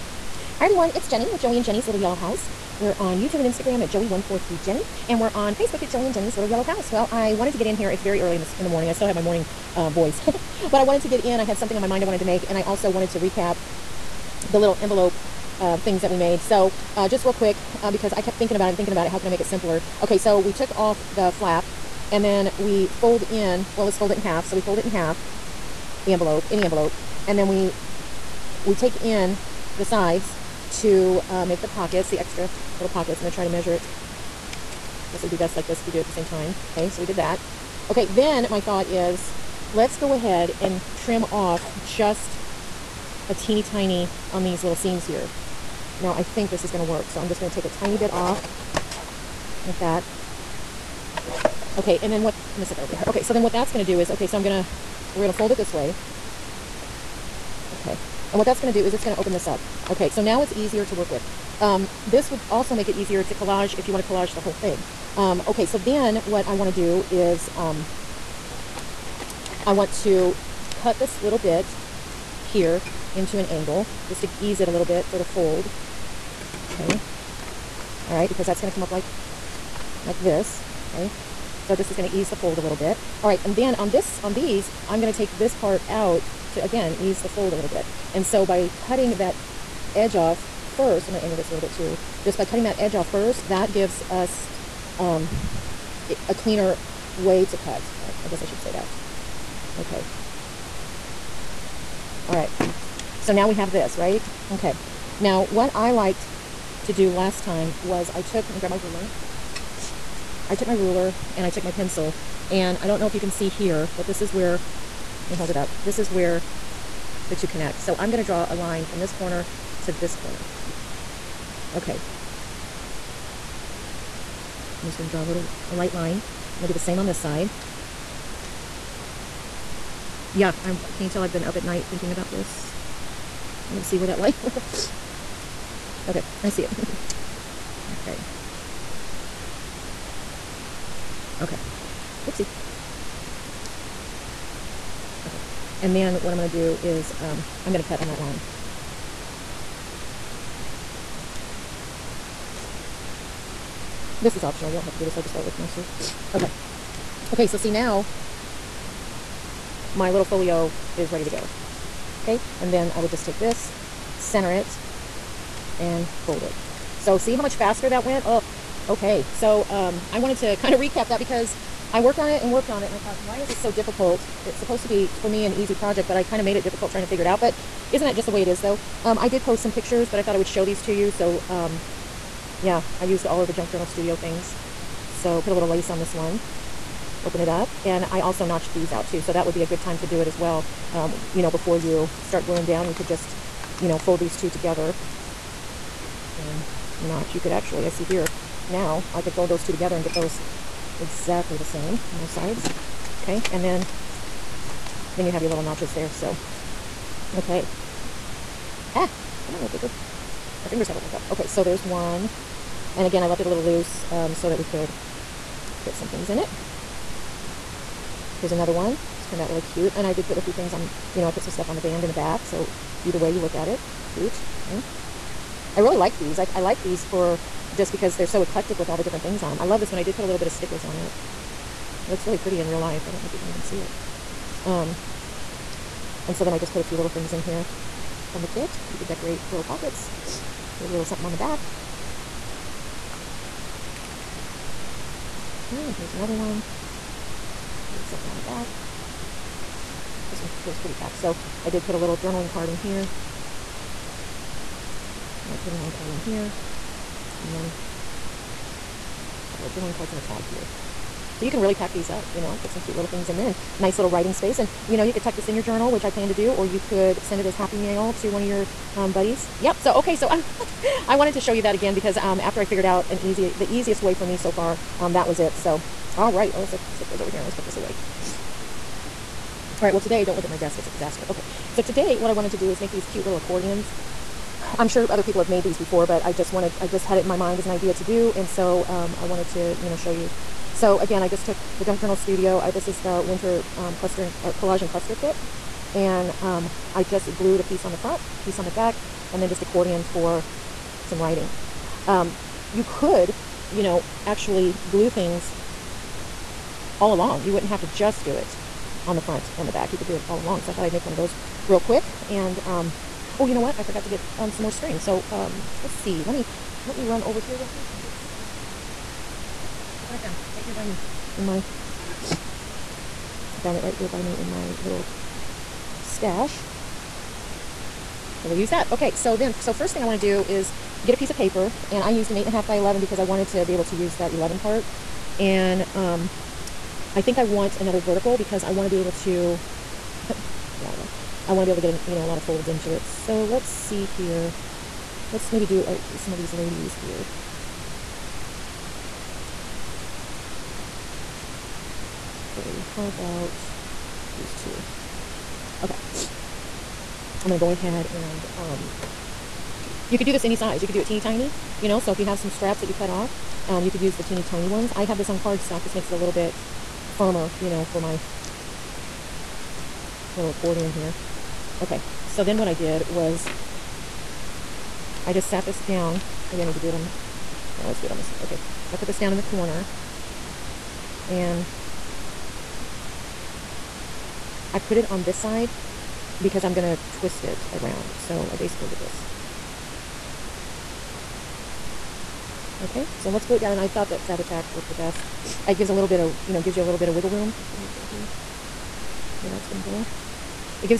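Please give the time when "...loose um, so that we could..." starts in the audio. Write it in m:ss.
3:33.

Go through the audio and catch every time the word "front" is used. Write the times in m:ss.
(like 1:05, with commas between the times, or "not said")
4:57, 5:09.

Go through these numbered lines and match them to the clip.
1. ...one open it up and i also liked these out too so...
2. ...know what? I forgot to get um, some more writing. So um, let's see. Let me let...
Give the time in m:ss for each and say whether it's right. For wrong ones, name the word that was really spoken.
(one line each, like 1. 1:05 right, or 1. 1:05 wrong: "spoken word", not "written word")
1. 3:06 wrong: "notched", not "liked"
2. 5:13 wrong: "string", not "writing".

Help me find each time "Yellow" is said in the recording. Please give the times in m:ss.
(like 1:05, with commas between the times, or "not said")
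0:01, 0:06.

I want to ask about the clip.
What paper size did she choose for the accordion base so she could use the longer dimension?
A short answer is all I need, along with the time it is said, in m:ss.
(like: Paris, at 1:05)
8.5 by 11, at 5:32.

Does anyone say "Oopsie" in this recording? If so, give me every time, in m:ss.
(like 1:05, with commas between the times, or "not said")
2:22.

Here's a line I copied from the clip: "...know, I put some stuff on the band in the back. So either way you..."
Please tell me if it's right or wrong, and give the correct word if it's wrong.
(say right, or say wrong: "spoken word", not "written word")
right.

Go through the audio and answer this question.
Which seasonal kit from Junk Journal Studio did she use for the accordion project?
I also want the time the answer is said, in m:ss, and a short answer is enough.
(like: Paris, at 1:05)
winter, at 4:53.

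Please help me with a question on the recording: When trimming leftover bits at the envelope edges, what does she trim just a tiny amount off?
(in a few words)
seams.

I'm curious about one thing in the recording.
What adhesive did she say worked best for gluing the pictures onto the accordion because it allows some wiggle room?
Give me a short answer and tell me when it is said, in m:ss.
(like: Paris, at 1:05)
Fabri-Tac, at 6:34.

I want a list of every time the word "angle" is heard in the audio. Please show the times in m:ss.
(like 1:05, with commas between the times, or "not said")
1:13, 1:31.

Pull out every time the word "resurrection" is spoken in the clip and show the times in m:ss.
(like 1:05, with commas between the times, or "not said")
not said.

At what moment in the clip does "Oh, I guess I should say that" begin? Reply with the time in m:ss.
1:38.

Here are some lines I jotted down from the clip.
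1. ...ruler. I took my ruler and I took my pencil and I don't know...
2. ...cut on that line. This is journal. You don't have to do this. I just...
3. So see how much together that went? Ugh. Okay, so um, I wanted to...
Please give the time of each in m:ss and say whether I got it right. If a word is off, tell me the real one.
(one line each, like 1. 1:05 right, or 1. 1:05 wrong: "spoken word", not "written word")
1. 1:48 right
2. 2:27 wrong: "optional", not "journal"
3. 2:46 wrong: "faster", not "together".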